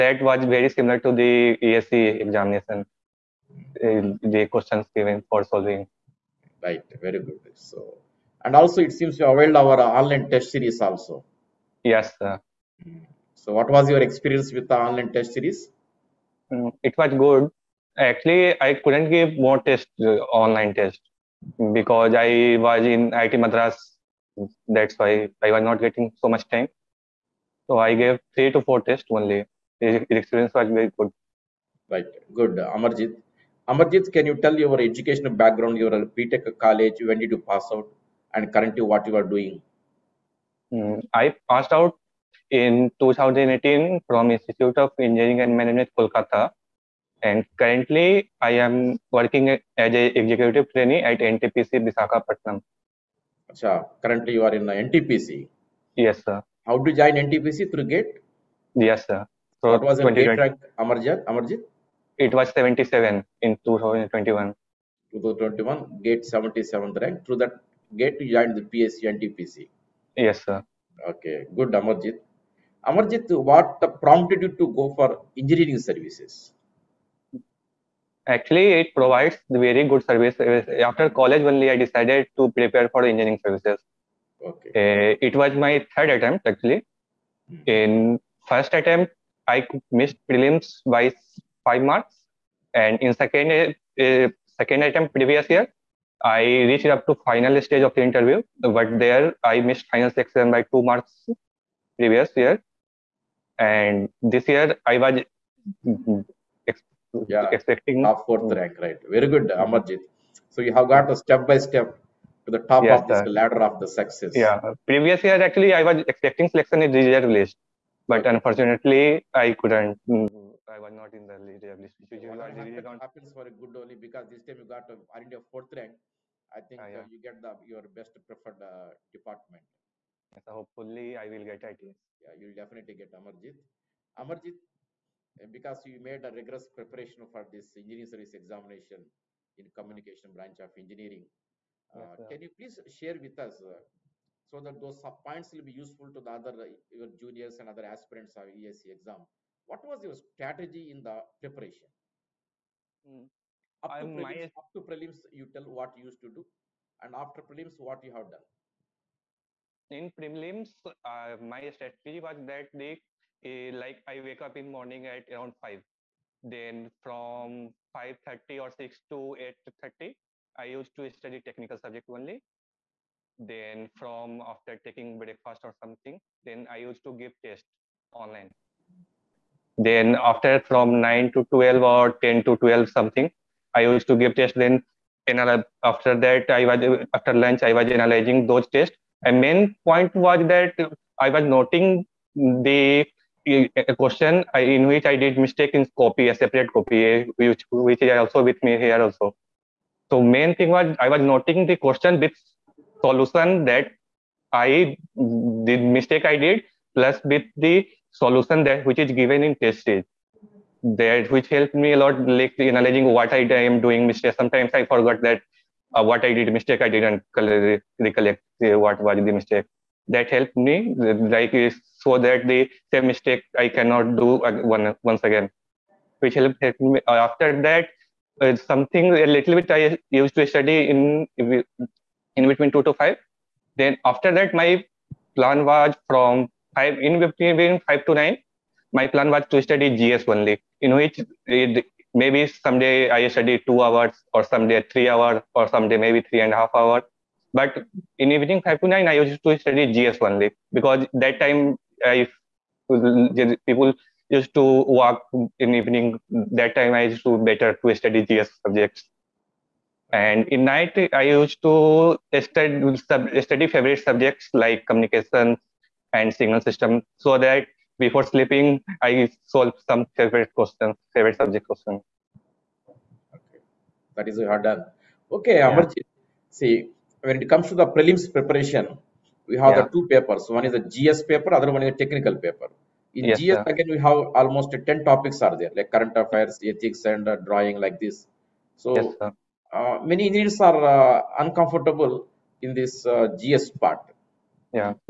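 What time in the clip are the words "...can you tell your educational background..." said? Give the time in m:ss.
0:34.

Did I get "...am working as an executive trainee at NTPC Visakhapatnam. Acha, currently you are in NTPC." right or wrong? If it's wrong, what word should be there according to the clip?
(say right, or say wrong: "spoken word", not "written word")
right.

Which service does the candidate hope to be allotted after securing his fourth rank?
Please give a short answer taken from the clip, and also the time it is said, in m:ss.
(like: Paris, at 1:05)
ITS, at 2:11.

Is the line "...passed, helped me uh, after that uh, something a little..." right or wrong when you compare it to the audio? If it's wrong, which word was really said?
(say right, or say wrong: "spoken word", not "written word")
wrong: "helped", not "passed".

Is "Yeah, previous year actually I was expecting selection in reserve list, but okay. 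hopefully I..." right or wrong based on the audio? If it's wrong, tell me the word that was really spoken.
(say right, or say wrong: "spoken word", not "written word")
wrong: "unfortunately", not "hopefully".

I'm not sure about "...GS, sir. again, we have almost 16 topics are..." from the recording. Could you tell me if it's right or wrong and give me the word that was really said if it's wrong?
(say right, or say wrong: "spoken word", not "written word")
wrong: "10", not "16".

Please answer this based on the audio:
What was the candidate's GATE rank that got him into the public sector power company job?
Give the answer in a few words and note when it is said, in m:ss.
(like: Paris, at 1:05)
77, at 1:02.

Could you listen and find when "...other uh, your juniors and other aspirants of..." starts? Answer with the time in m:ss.
2:26.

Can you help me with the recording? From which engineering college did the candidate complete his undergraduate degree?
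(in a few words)
Institute of Engineering and Management, Kolkata.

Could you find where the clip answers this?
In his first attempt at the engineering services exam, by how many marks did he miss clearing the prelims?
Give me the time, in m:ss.
1:31.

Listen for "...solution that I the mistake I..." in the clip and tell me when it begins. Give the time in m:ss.
3:23.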